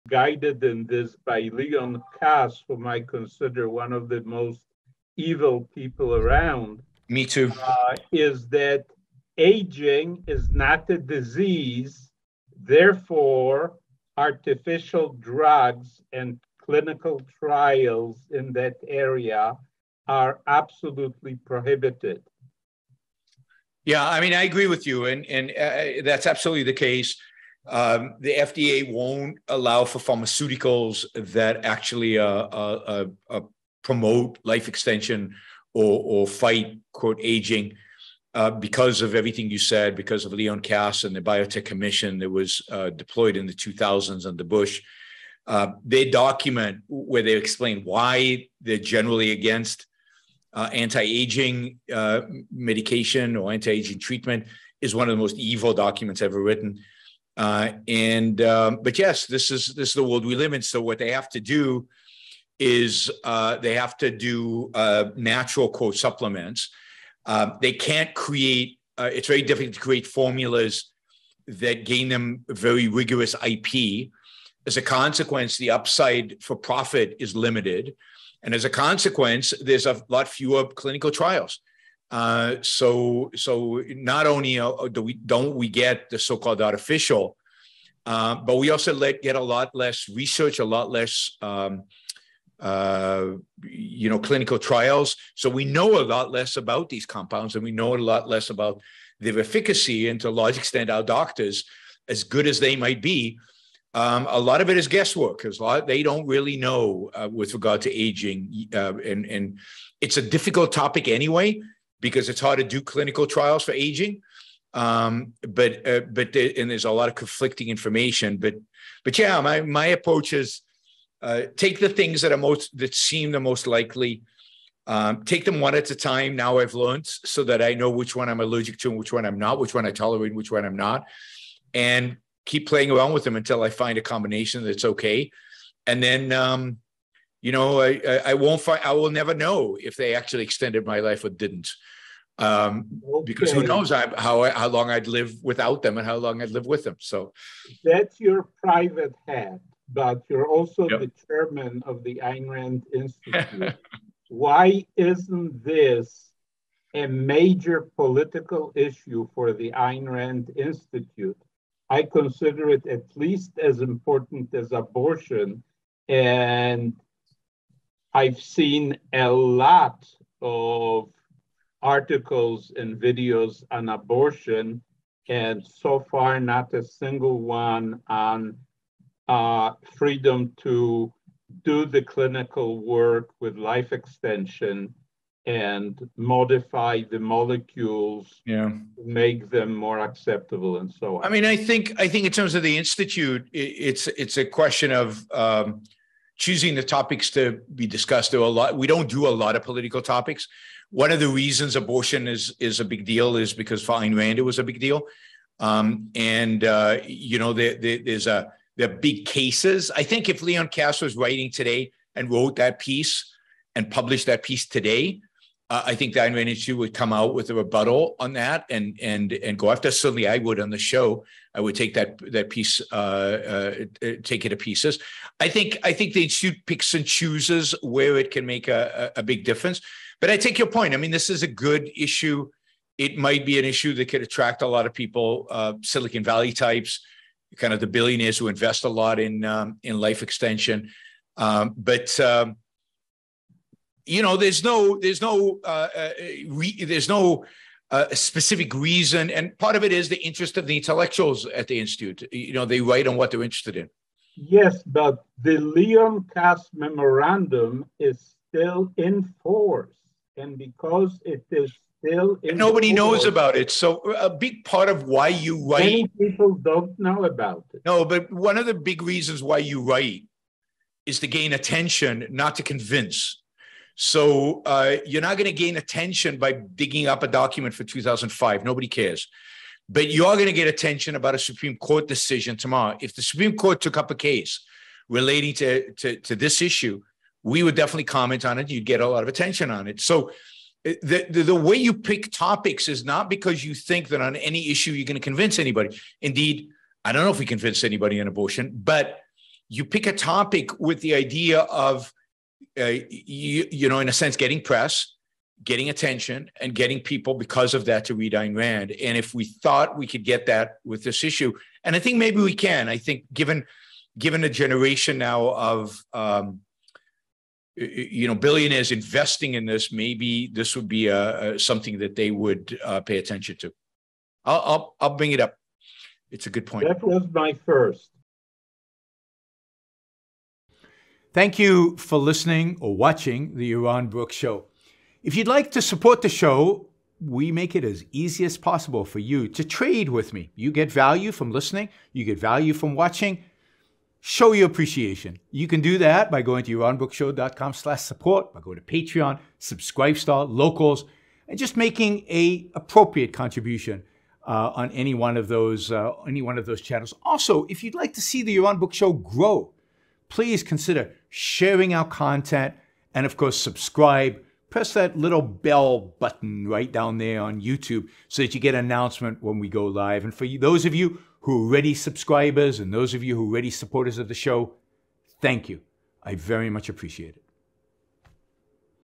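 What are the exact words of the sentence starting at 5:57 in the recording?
Also, if you'd like to see the Yaron Brook Show grow, please consider sharing our content and, of course, subscribe.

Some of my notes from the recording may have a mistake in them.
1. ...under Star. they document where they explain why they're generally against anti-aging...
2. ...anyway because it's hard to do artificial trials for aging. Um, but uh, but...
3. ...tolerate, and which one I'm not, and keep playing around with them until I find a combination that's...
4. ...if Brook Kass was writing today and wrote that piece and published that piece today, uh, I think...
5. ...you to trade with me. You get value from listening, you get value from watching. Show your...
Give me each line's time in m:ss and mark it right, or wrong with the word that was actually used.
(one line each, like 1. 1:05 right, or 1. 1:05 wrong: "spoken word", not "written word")
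1. 0:44 wrong: "Bush", not "Star"
2. 1:51 wrong: "clinical", not "artificial"
3. 2:09 right
4. 3:30 wrong: "Leon", not "Brook"
5. 5:39 right.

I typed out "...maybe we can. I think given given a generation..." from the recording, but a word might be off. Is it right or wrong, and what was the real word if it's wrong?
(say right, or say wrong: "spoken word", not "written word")
right.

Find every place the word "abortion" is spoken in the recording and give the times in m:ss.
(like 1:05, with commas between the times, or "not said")
2:44, 2:53, 3:21, 4:58.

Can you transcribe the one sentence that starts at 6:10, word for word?
And for those of you who are already subscribers and those of you who are already supporters of the show, thank you.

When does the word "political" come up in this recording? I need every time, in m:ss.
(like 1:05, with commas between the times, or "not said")
2:37, 3:19.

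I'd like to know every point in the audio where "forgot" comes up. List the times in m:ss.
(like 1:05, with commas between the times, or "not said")
not said.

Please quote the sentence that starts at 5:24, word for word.
I'll, I'll I'll bring it up.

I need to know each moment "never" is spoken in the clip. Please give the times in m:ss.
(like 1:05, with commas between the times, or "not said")
2:19.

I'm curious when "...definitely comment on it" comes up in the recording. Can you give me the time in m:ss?
4:47.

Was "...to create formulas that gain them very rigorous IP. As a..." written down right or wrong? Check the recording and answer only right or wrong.
right.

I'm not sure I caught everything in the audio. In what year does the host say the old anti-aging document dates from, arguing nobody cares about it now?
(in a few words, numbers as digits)
2005.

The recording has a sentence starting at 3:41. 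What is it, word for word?
I would take that that piece, uh, uh, uh take it to pieces.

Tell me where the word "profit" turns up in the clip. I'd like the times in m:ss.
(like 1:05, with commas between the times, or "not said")
1:16.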